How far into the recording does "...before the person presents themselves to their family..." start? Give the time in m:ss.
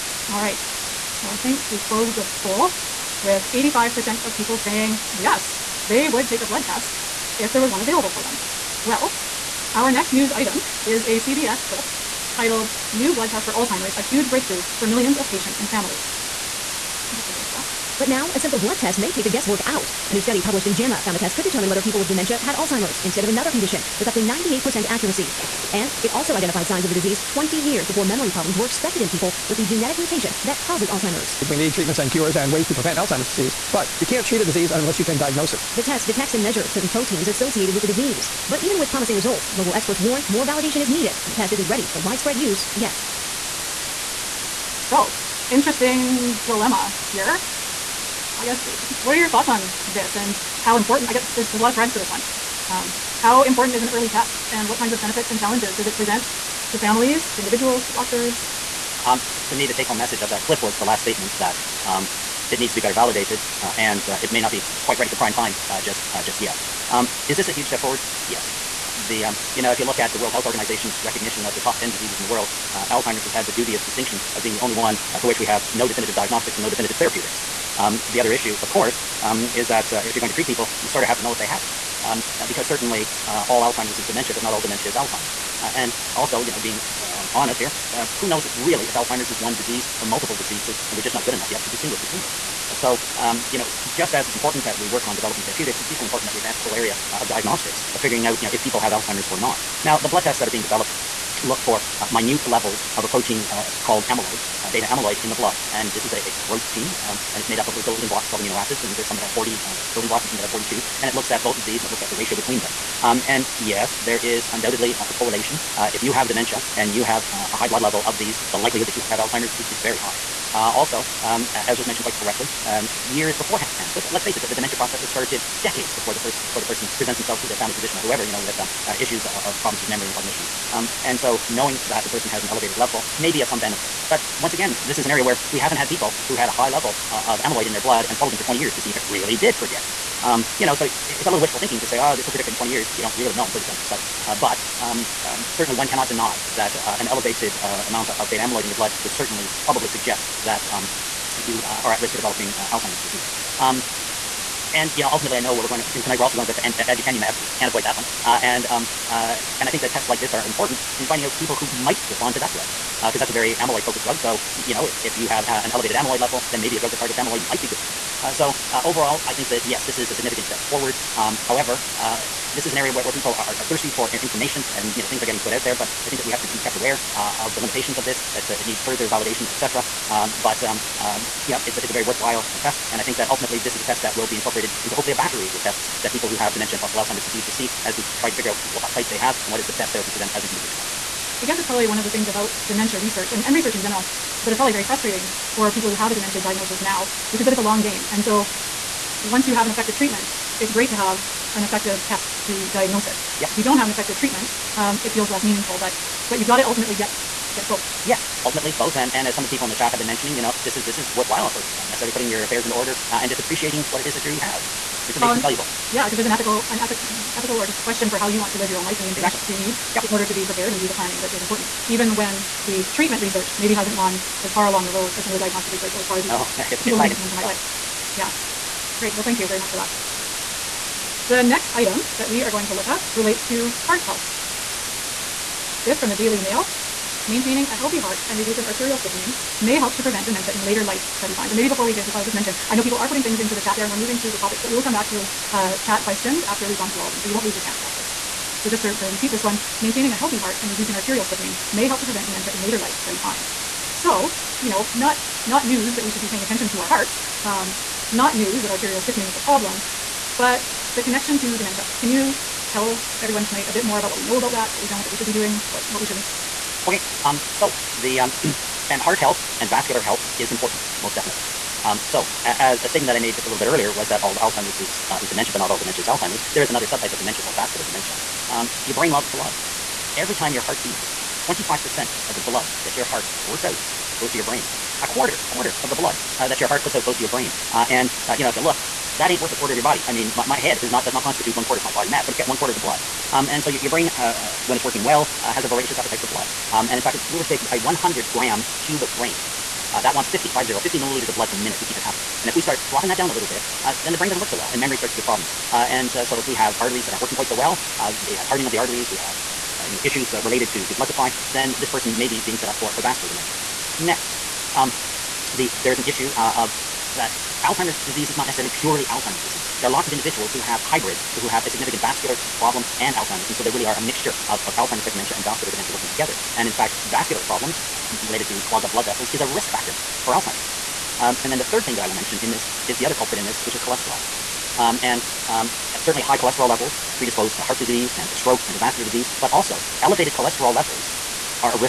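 2:06.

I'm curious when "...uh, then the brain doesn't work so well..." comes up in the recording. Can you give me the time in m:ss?
5:03.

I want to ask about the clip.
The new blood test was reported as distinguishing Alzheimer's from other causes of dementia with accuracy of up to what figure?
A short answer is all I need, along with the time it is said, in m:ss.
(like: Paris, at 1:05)
98%, at 0:24.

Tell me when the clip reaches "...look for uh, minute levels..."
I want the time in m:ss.
1:41.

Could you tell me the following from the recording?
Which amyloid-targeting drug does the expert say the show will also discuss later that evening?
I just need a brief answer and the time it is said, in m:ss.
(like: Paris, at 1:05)
aducanumab, at 2:36.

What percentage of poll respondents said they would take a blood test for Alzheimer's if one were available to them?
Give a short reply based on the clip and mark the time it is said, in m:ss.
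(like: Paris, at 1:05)
85%, at 0:03.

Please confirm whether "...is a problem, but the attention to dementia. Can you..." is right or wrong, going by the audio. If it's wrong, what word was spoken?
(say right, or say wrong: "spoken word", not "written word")
wrong: "connection", not "attention".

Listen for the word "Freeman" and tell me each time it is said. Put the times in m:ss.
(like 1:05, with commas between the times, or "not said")
not said.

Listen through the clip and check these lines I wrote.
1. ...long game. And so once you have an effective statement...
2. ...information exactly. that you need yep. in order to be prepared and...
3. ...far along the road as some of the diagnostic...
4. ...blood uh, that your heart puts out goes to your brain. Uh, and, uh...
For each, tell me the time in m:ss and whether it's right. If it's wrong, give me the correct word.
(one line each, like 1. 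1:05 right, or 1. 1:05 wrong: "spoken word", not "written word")
1. 3:17 wrong: "treatment", not "statement"
2. 3:39 right
3. 3:44 right
4. 4:45 right.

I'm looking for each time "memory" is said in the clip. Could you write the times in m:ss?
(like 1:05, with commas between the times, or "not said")
0:28, 2:09, 5:04.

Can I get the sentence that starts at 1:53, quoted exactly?
Um, and yes, there is undoubtedly a, a correlation.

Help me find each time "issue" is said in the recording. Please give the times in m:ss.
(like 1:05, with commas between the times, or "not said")
1:18, 2:08, 5:10, 5:16.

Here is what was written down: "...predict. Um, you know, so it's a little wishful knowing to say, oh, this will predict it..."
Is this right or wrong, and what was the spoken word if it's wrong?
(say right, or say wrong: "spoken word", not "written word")
wrong: "thinking", not "knowing".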